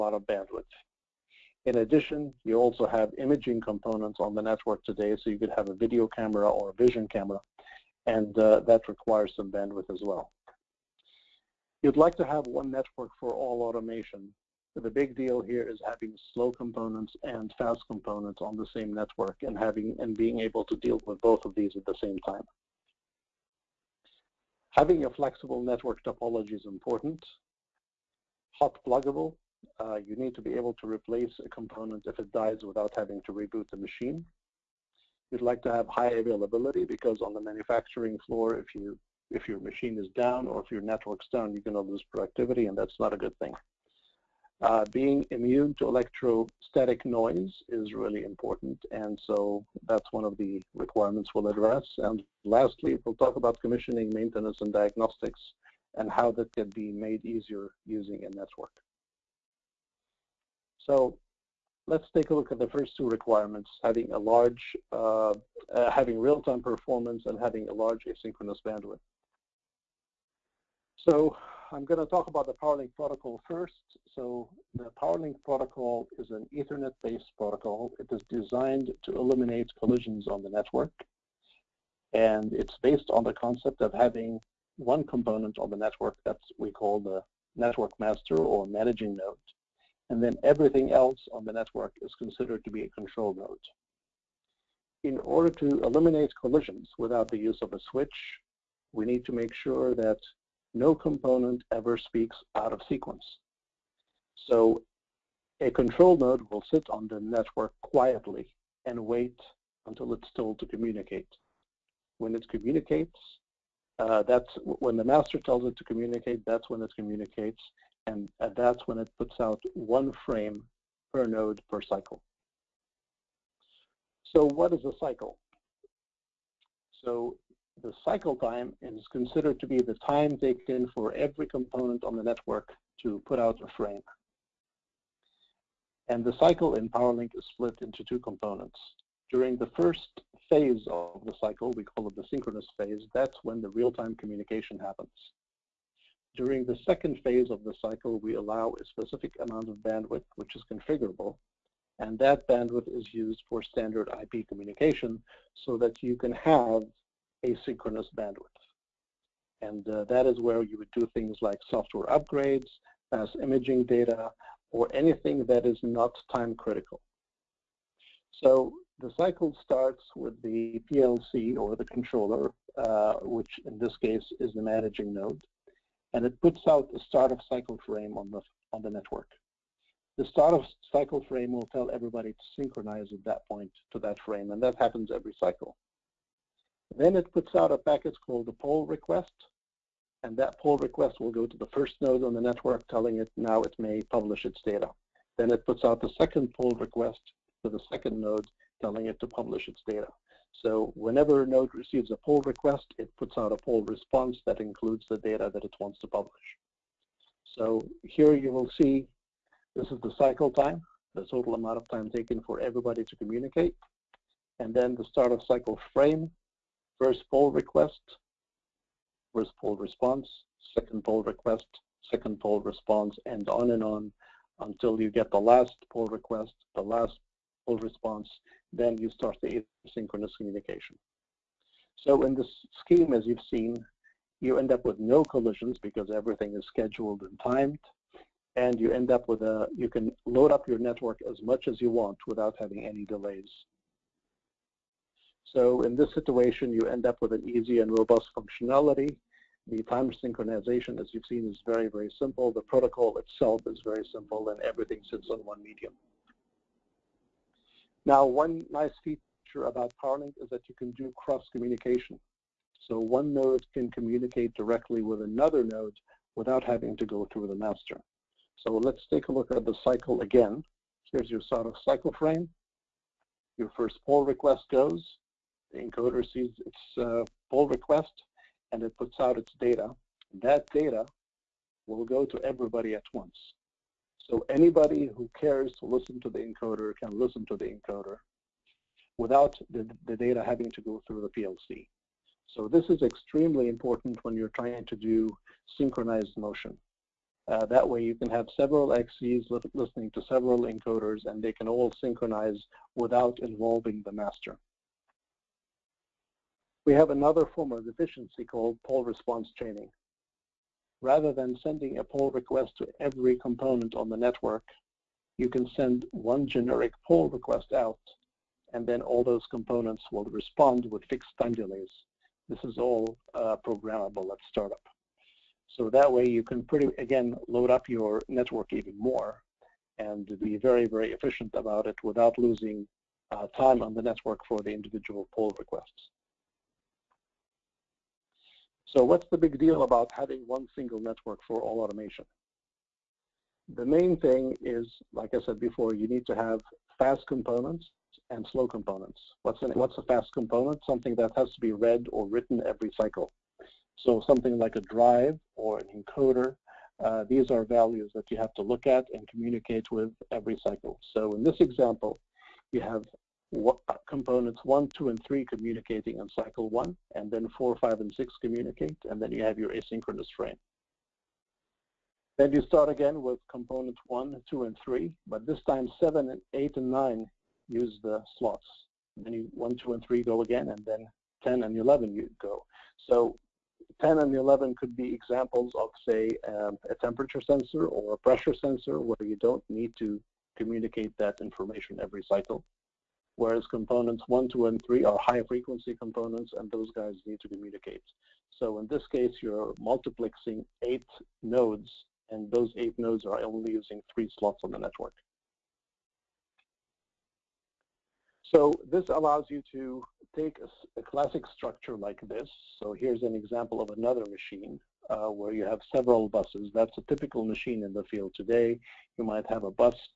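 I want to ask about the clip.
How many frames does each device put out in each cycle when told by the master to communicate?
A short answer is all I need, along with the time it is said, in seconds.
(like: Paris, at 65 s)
1, at 119 s.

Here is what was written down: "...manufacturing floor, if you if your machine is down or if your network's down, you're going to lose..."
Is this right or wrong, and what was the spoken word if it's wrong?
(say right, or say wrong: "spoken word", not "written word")
right.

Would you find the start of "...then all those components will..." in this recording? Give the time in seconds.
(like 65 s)
318 s.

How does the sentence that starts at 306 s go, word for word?
We have another form of efficiency called poll response chaining.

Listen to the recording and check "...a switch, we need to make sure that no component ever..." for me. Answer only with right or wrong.
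right.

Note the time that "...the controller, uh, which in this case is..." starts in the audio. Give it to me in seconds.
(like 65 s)
171 s.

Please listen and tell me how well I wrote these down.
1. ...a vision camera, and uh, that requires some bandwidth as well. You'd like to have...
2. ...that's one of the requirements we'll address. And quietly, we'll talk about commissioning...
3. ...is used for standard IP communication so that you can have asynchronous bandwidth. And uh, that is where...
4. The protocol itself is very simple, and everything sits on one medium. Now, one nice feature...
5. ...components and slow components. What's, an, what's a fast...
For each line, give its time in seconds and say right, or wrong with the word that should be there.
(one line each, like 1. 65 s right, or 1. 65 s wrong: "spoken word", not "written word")
1. 6 s right
2. 49 s wrong: "lastly", not "quietly"
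3. 152 s right
4. 252 s right
5. 347 s right.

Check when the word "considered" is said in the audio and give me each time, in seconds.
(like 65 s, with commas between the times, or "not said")
92 s, 129 s.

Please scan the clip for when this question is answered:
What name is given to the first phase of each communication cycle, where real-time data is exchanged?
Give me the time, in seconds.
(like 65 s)
142 s.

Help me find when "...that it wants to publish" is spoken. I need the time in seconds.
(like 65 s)
205 s.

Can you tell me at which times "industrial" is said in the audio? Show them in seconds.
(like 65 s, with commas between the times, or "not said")
not said.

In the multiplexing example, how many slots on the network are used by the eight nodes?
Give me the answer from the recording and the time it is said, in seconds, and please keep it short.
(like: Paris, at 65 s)
3, at 404 s.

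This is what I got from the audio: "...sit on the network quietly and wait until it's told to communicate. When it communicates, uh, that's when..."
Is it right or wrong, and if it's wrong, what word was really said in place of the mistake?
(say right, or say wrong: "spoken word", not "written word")
right.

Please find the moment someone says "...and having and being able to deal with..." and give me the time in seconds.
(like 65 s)
19 s.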